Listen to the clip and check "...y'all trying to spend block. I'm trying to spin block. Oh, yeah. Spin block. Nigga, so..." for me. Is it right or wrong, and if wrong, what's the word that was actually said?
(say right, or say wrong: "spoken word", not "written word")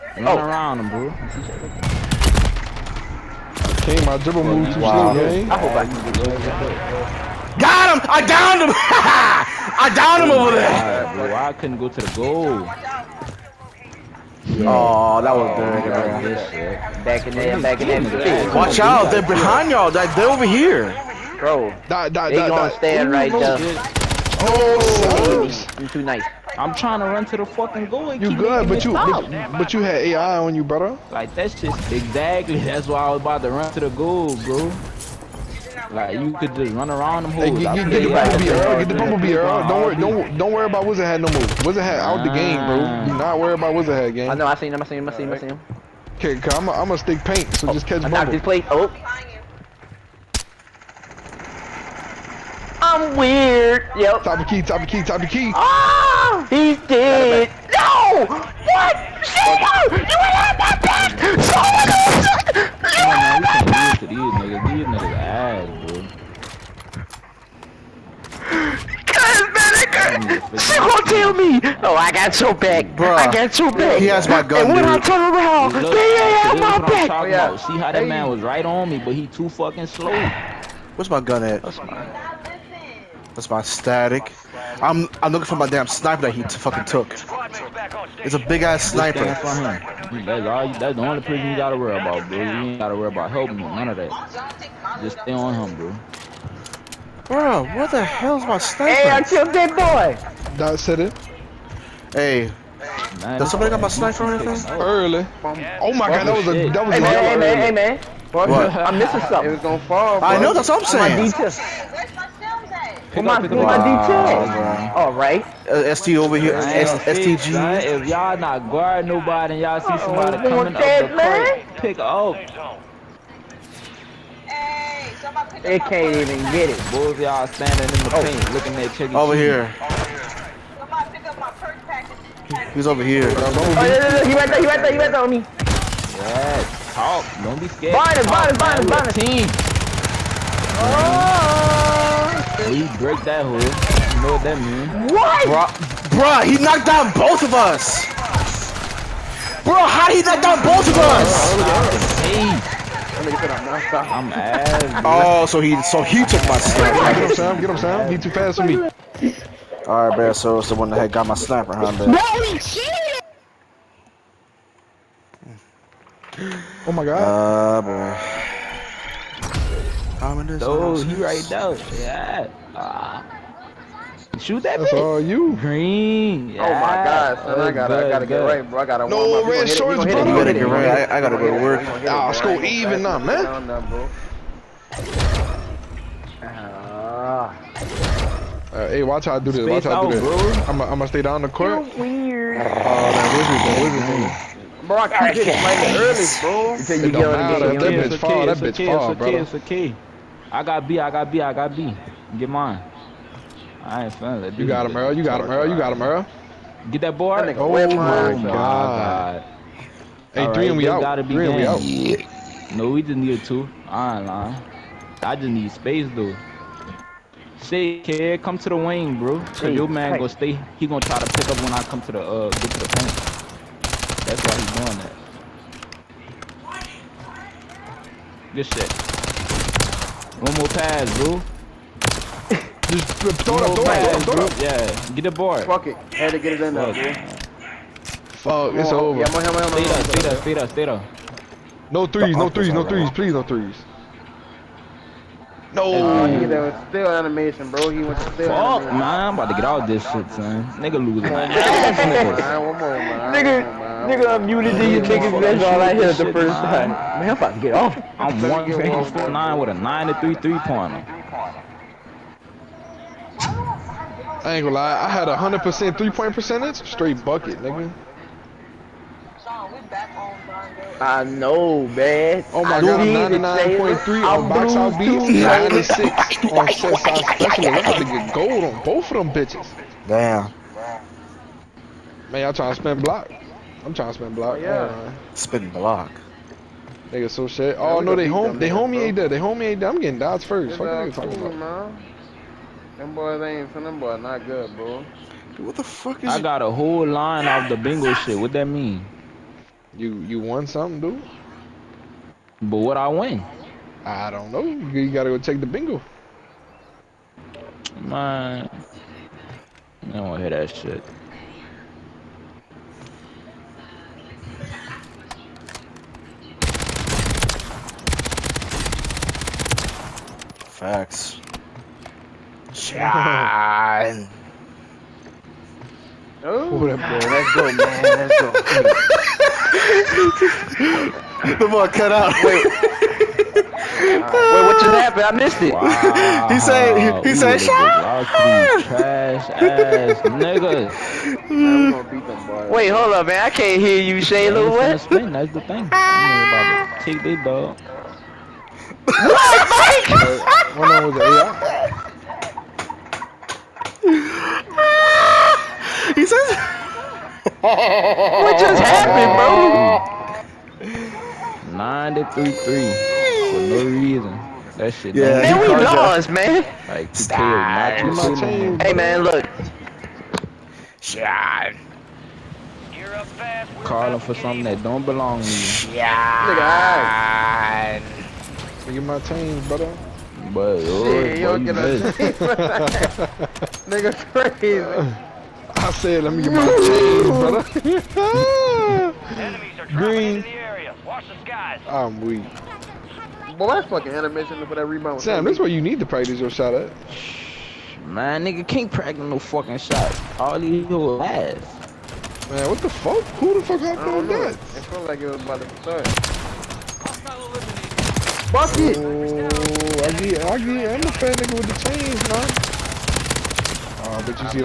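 right.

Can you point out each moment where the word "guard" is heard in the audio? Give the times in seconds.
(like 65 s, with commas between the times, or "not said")
118 s.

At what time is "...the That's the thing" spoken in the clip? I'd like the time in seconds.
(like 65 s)
345 s.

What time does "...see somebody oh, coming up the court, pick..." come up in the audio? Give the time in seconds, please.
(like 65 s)
119 s.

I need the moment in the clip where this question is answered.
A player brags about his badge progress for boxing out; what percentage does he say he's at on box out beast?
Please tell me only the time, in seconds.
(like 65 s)
273 s.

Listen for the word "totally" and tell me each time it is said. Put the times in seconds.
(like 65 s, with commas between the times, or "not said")
not said.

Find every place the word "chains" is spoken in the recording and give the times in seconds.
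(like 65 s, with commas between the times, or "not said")
411 s.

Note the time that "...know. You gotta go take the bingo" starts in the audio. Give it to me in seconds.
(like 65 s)
304 s.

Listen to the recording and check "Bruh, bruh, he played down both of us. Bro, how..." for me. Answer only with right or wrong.
wrong.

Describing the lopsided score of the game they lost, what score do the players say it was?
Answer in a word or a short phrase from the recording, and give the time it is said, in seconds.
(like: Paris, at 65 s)
9 to 3, at 361 s.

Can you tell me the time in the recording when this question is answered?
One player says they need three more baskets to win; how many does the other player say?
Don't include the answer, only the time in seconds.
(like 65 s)
212 s.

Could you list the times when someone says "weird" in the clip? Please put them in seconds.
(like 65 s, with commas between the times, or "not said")
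53 s, 191 s.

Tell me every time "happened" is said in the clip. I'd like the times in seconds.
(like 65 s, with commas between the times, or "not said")
335 s, 358 s, 403 s.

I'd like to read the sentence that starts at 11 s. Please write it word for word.
God, bro, I couldn't go to the goal.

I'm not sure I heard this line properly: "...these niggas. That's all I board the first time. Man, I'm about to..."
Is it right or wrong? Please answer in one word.
wrong.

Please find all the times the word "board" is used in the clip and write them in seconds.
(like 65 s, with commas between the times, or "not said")
207 s, 235 s.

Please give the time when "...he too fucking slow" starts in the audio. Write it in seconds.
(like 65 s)
79 s.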